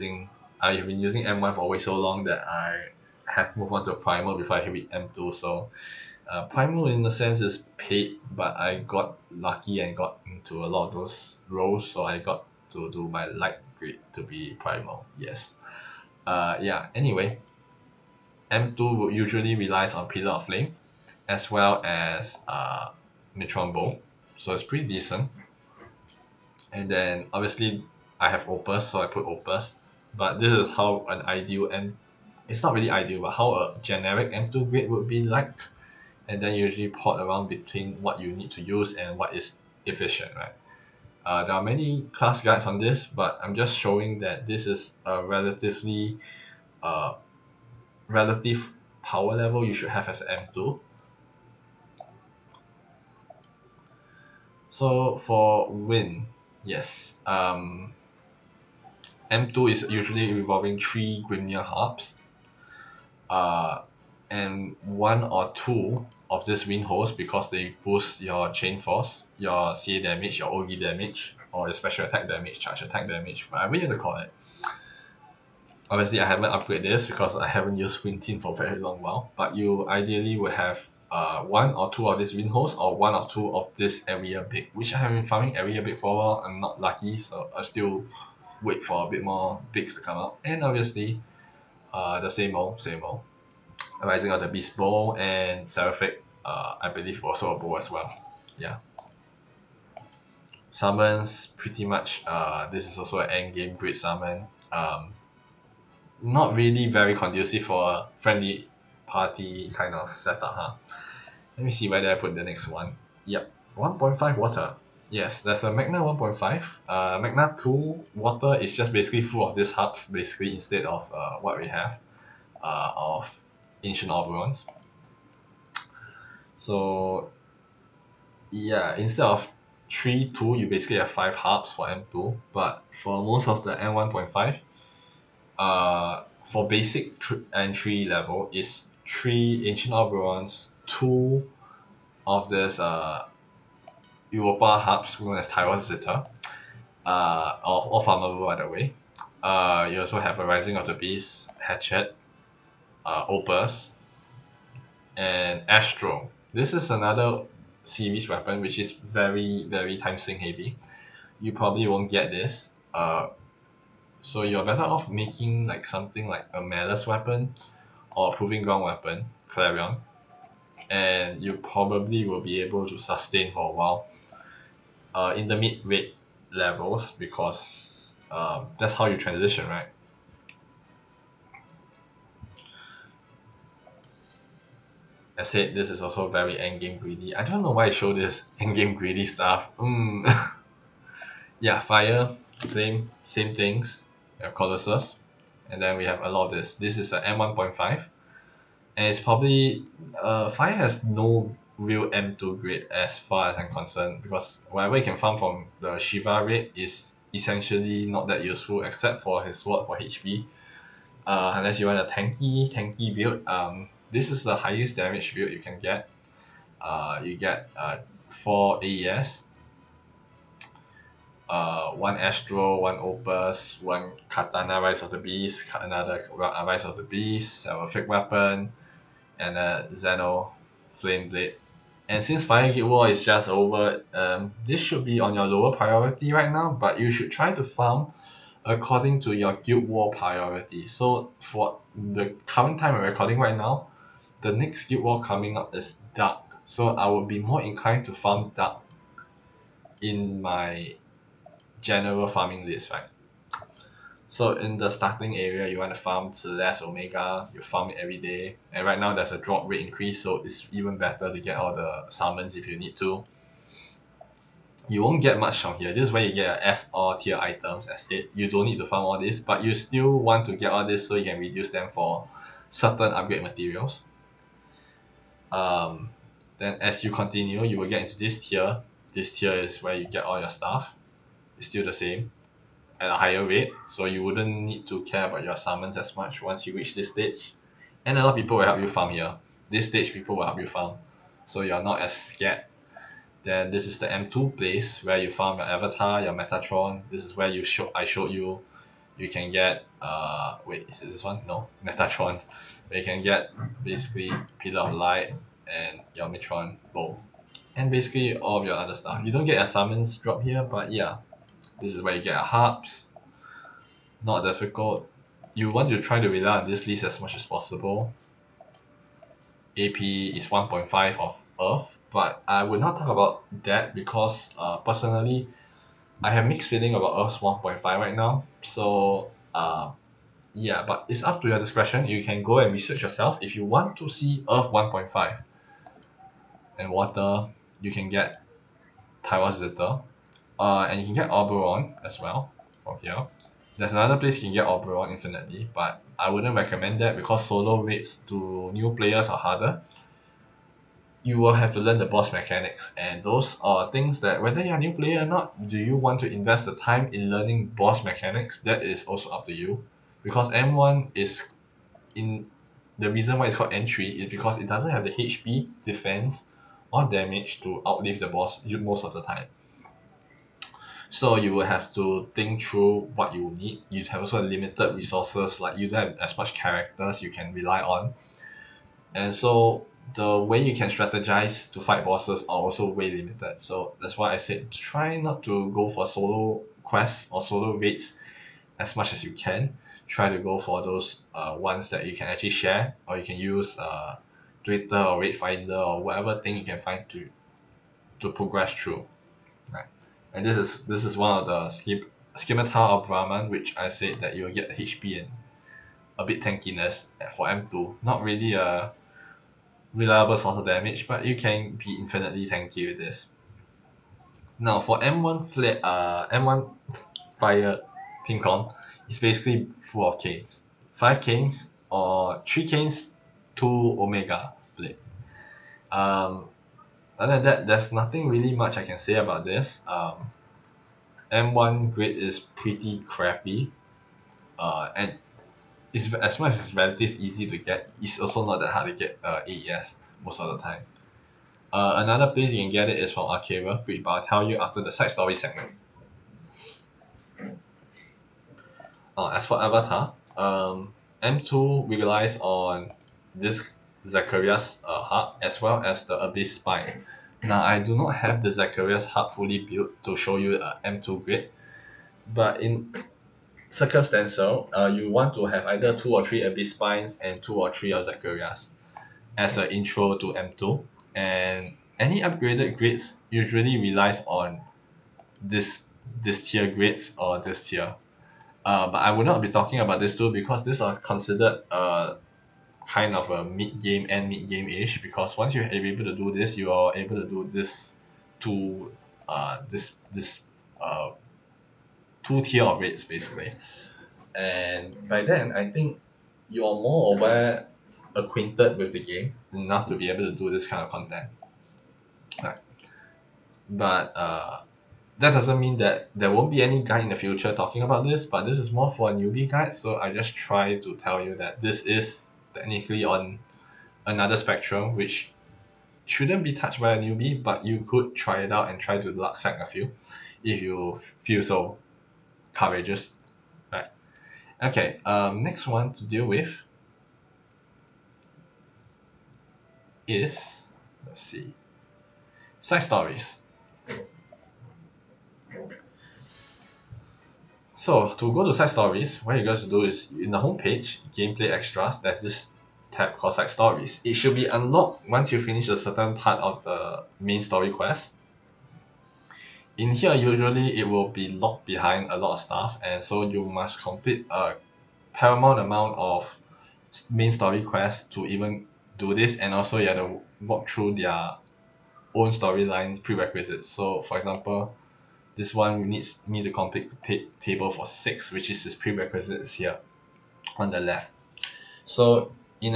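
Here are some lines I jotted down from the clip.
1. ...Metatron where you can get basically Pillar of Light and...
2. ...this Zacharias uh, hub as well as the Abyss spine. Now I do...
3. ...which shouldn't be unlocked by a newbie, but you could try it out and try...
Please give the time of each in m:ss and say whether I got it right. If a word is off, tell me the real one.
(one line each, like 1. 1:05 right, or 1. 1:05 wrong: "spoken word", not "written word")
1. 5:01 right
2. 7:33 right
3. 8:34 wrong: "touched", not "unlocked".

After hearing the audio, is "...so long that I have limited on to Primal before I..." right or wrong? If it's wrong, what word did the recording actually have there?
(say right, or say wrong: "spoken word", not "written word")
wrong: "moved", not "limited".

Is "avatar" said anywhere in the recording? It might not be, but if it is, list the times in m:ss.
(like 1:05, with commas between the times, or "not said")
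4:55, 7:29.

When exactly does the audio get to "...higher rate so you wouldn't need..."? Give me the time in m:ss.
4:43.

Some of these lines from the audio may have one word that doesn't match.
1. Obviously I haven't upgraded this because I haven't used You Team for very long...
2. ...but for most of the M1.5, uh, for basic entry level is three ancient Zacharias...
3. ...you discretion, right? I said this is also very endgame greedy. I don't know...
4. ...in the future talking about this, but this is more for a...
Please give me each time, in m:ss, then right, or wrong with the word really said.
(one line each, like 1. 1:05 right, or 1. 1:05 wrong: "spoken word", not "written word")
1. 1:15 wrong: "Wind", not "You"
2. 2:12 wrong: "Alberons", not "Zacharias"
3. 2:59 wrong: "transition", not "discretion"
4. 8:27 right.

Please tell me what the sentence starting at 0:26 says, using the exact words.
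And then obviously I have Opus, so I put Opus.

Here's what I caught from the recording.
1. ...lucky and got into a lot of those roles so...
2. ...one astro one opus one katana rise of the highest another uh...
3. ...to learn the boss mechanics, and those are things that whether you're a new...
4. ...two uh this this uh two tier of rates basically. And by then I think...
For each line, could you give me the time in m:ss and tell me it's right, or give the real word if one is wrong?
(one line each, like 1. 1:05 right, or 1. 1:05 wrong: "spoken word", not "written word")
1. 0:09 right
2. 3:41 wrong: "beast", not "highest"
3. 5:51 right
4. 8:08 right.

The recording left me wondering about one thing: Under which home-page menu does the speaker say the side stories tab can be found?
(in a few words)
Gameplay Extras.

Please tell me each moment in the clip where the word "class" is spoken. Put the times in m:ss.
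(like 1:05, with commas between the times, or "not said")
0:42.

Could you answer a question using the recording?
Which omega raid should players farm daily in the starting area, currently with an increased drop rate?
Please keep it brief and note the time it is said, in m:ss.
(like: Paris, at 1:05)
Celeste Omega, at 4:16.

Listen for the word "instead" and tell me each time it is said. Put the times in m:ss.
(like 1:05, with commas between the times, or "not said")
2:00, 2:08.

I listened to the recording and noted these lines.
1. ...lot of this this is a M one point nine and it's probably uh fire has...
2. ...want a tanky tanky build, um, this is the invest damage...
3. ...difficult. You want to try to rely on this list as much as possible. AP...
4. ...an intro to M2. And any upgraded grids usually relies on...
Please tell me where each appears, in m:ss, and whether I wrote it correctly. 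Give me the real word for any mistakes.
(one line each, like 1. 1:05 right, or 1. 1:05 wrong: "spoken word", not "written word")
1. 3:16 wrong: "five", not "nine"
2. 3:31 wrong: "highest", not "invest"
3. 5:14 right
4. 7:49 right.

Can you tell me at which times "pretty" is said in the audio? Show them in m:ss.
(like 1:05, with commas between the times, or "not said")
0:24, 1:41, 7:12.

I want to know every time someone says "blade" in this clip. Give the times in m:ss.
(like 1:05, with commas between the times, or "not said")
3:51, 7:04.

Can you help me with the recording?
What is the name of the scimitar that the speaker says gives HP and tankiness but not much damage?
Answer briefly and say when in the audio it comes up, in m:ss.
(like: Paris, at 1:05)
Scimitar of Brahman, at 6:42.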